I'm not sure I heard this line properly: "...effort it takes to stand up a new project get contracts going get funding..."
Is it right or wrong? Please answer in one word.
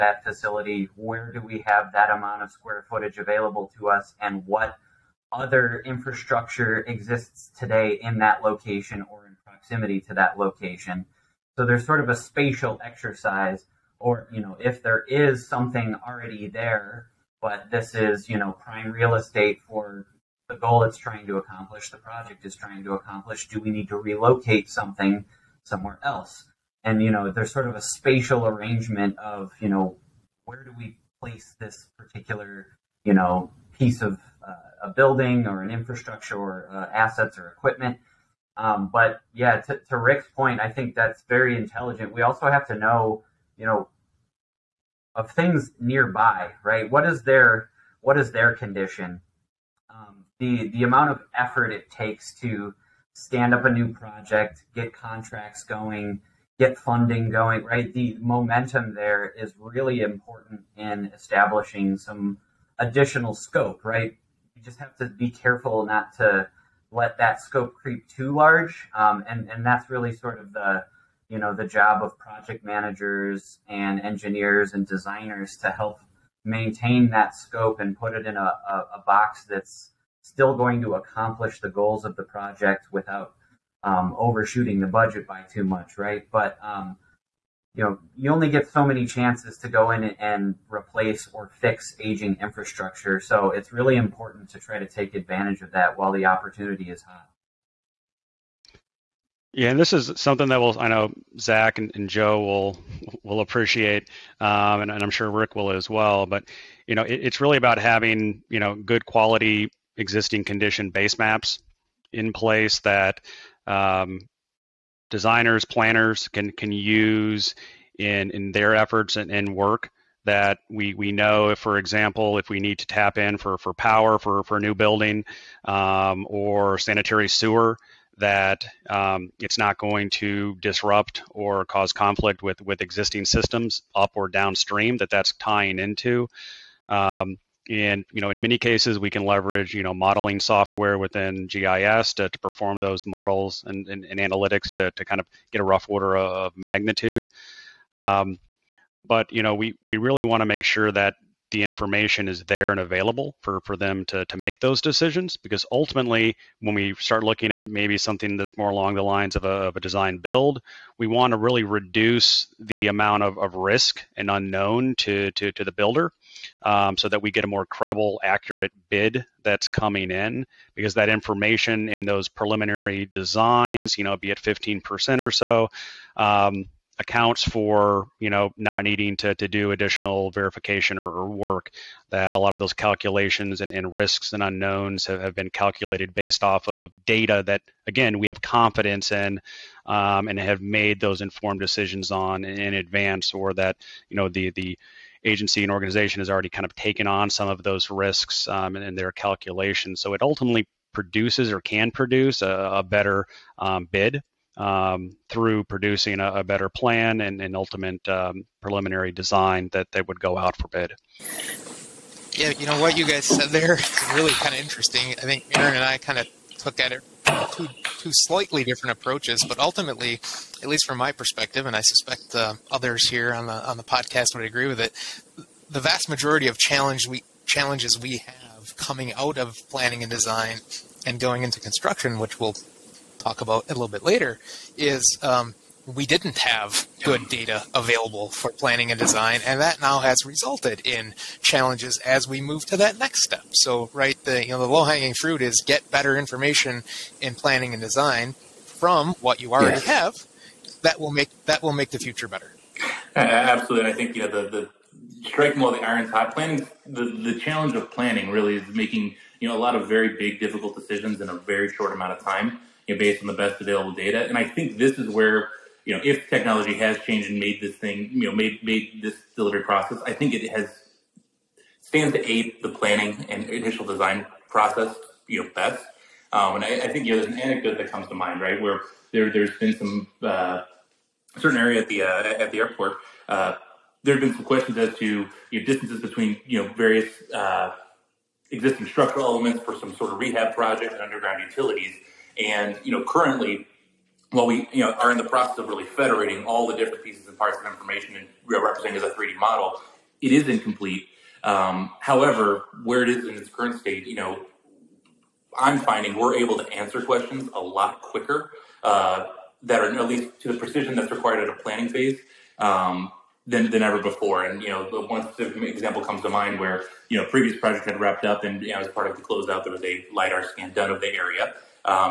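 right.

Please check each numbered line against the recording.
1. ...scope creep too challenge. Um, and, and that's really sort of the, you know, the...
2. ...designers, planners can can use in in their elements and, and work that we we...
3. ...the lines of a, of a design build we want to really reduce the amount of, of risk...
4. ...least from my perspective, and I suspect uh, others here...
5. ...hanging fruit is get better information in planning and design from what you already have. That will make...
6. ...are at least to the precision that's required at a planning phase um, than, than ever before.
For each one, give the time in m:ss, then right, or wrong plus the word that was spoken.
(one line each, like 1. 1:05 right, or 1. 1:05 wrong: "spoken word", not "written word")
1. 1:07 wrong: "large", not "challenge"
2. 1:55 wrong: "efforts", not "elements"
3. 2:38 right
4. 3:40 right
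5. 4:04 right
6. 5:09 right.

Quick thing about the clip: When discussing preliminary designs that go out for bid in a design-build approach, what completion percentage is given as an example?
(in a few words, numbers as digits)
15%.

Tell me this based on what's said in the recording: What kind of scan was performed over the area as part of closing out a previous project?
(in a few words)
lidar scan.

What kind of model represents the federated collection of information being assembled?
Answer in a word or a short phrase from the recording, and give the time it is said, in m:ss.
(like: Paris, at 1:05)
3D model, at 4:59.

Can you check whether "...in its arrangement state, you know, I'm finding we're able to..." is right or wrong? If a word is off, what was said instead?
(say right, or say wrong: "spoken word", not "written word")
wrong: "current", not "arrangement".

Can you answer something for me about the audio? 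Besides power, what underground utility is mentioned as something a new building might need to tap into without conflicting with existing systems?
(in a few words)
sanitary sewer.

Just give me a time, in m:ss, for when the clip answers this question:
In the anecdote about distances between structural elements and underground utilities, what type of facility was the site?
4:42.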